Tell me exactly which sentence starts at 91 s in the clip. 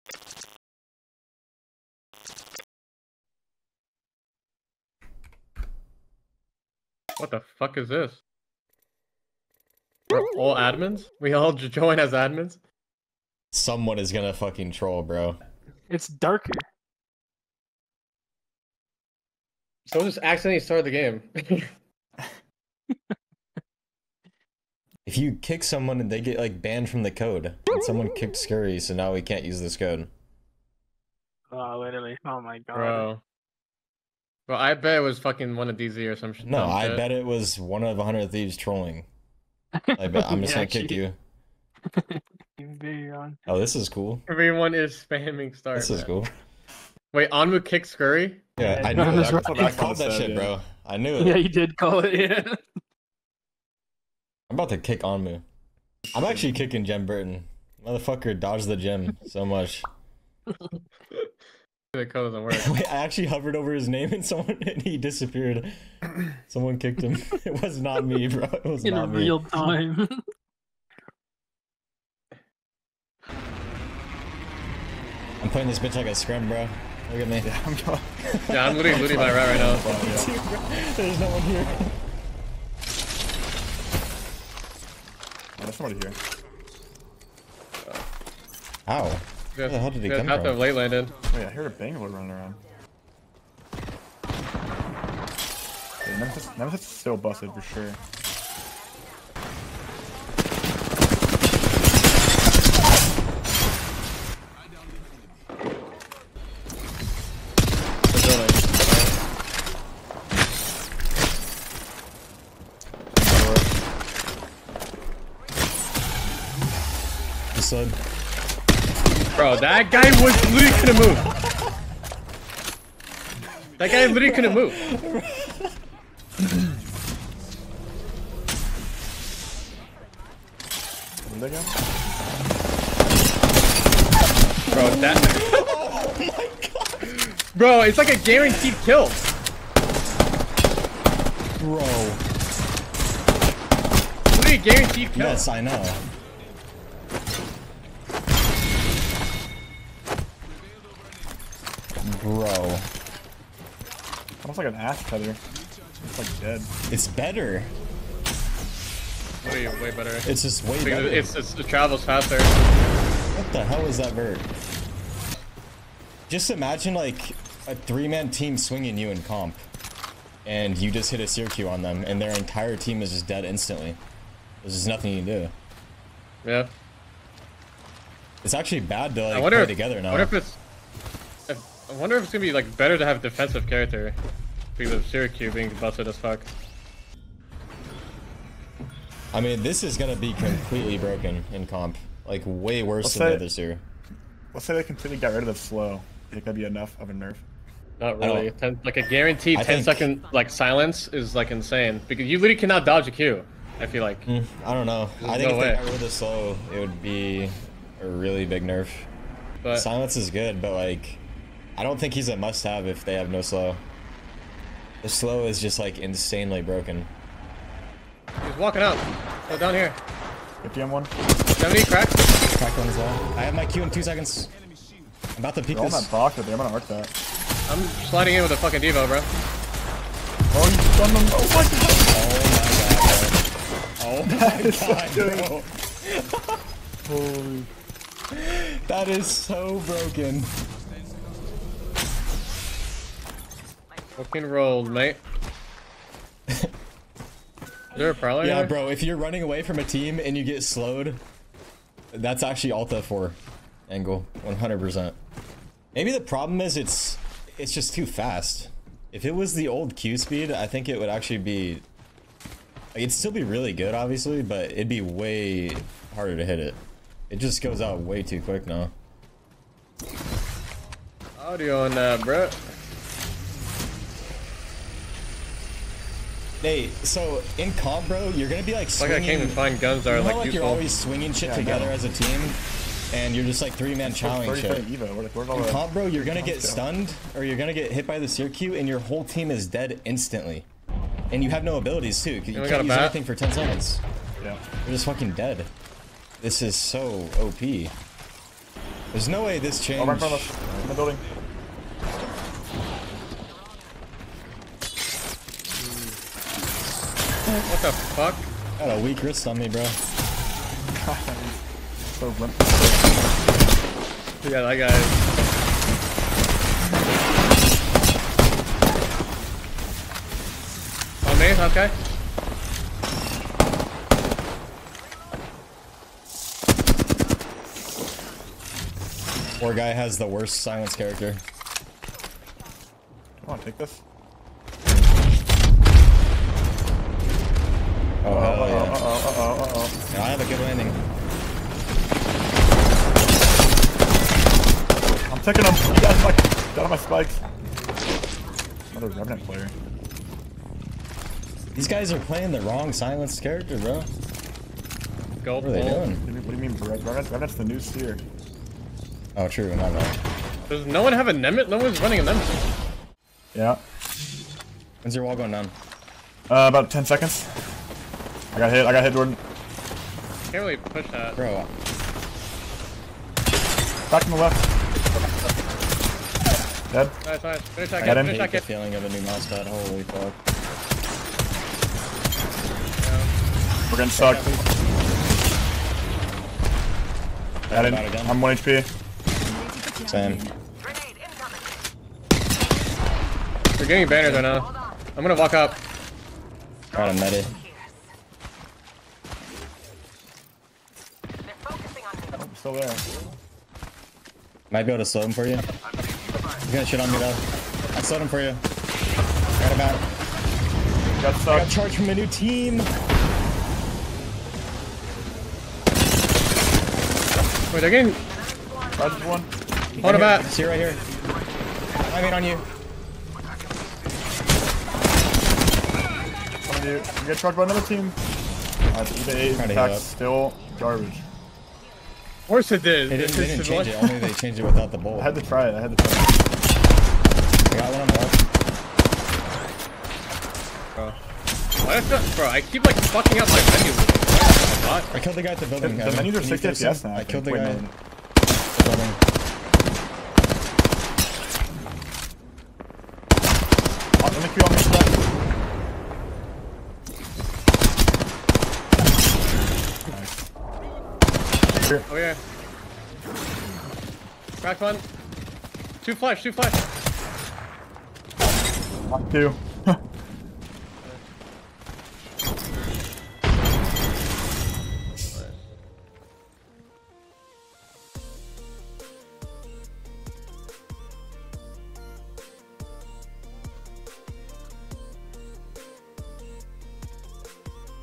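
Oh, Wait, I heard a Bangalore running around.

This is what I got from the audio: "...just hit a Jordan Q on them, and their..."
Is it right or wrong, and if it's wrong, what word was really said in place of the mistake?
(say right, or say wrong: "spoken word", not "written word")
wrong: "Seer", not "Jordan".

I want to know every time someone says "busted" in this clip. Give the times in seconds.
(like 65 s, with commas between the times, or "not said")
97 s, 185 s.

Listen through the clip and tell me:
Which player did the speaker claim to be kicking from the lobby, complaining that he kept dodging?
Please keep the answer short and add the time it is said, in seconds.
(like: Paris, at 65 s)
Jem Burton, at 56 s.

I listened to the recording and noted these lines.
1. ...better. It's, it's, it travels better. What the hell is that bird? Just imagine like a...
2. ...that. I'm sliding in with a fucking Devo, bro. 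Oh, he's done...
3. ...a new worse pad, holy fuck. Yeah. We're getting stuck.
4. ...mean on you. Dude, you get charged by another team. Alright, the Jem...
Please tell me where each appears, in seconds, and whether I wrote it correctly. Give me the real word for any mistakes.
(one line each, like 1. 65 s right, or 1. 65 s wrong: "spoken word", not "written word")
1. 160 s wrong: "faster", not "better"
2. 226 s right
3. 379 s wrong: "mouse", not "worse"
4. 422 s wrong: "EVA", not "Jem".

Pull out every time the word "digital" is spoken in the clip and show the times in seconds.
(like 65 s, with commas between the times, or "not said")
not said.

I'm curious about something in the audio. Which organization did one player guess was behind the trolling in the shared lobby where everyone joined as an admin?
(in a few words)
100 Thieves.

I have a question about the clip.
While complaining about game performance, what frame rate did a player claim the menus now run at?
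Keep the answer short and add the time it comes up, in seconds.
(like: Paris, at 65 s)
6 FPS, at 446 s.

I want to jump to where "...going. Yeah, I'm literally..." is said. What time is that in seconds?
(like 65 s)
77 s.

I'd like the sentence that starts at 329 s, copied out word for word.
Poor guy has the worst silence character.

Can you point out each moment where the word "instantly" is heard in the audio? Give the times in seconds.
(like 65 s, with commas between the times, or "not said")
173 s, 290 s.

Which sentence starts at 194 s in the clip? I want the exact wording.
Let's say they completely got rid of the slow.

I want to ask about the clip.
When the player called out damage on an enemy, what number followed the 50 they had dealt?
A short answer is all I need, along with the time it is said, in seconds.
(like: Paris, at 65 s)
70, at 221 s.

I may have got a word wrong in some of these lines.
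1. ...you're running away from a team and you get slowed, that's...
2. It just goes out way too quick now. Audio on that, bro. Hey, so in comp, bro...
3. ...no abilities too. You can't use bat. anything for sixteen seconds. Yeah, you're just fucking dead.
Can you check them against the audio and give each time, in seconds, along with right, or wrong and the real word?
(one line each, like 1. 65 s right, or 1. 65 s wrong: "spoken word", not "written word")
1. 249 s right
2. 267 s right
3. 291 s wrong: "ten", not "sixteen".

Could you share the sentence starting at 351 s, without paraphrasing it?
These guys are playing the wrong silenced character, bro.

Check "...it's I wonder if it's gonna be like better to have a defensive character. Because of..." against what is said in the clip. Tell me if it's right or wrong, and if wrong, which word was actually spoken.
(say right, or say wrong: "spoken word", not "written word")
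right.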